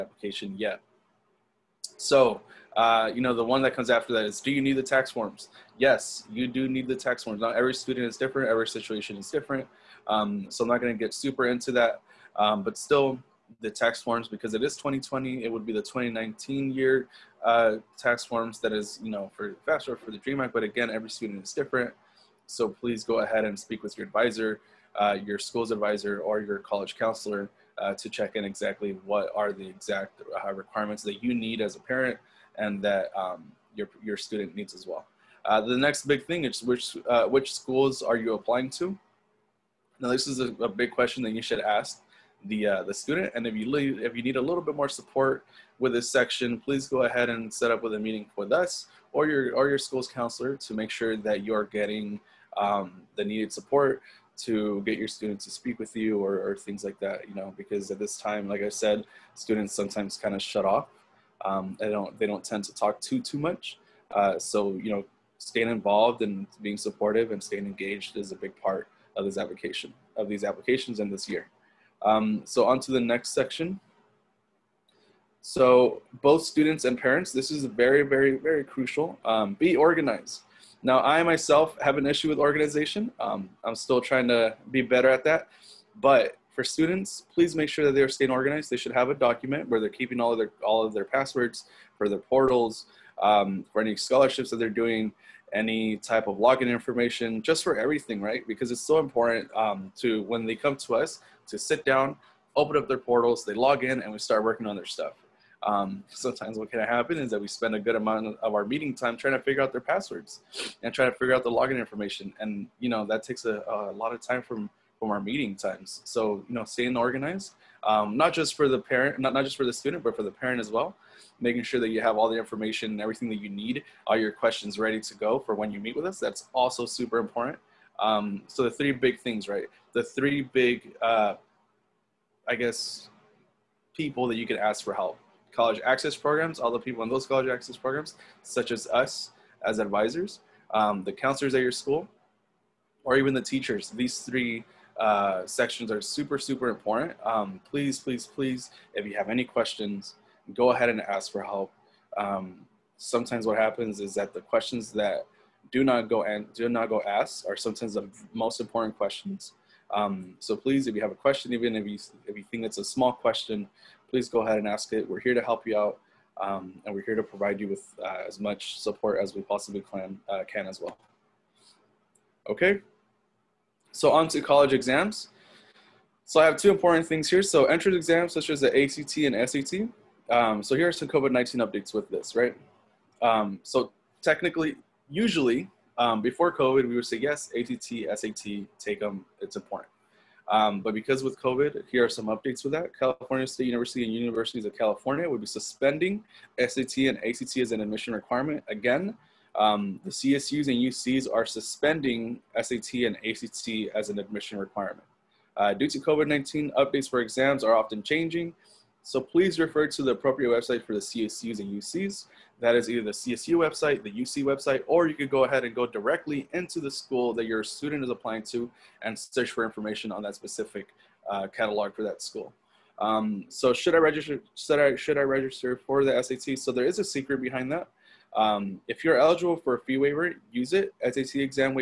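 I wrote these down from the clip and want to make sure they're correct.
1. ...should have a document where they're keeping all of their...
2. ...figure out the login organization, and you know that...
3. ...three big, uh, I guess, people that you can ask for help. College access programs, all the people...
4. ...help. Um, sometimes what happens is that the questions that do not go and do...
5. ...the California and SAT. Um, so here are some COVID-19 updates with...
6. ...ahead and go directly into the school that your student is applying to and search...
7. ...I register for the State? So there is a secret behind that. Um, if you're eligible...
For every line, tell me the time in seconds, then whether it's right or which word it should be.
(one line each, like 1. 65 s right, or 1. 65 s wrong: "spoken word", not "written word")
1. 88 s right
2. 111 s wrong: "information", not "organization"
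3. 130 s right
4. 151 s right
5. 178 s wrong: "ACT", not "California"
6. 215 s right
7. 225 s wrong: "SAT", not "State".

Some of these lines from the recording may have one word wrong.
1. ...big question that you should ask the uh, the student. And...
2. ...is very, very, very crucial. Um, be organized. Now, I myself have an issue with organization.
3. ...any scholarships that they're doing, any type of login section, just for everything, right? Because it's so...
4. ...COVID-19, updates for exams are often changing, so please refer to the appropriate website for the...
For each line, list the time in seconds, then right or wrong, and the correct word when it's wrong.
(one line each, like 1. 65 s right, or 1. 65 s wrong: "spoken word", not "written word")
1. 40 s right
2. 77 s right
3. 93 s wrong: "information", not "section"
4. 205 s right.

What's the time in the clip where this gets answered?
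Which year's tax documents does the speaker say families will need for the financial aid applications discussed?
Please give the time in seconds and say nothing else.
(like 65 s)
15 s.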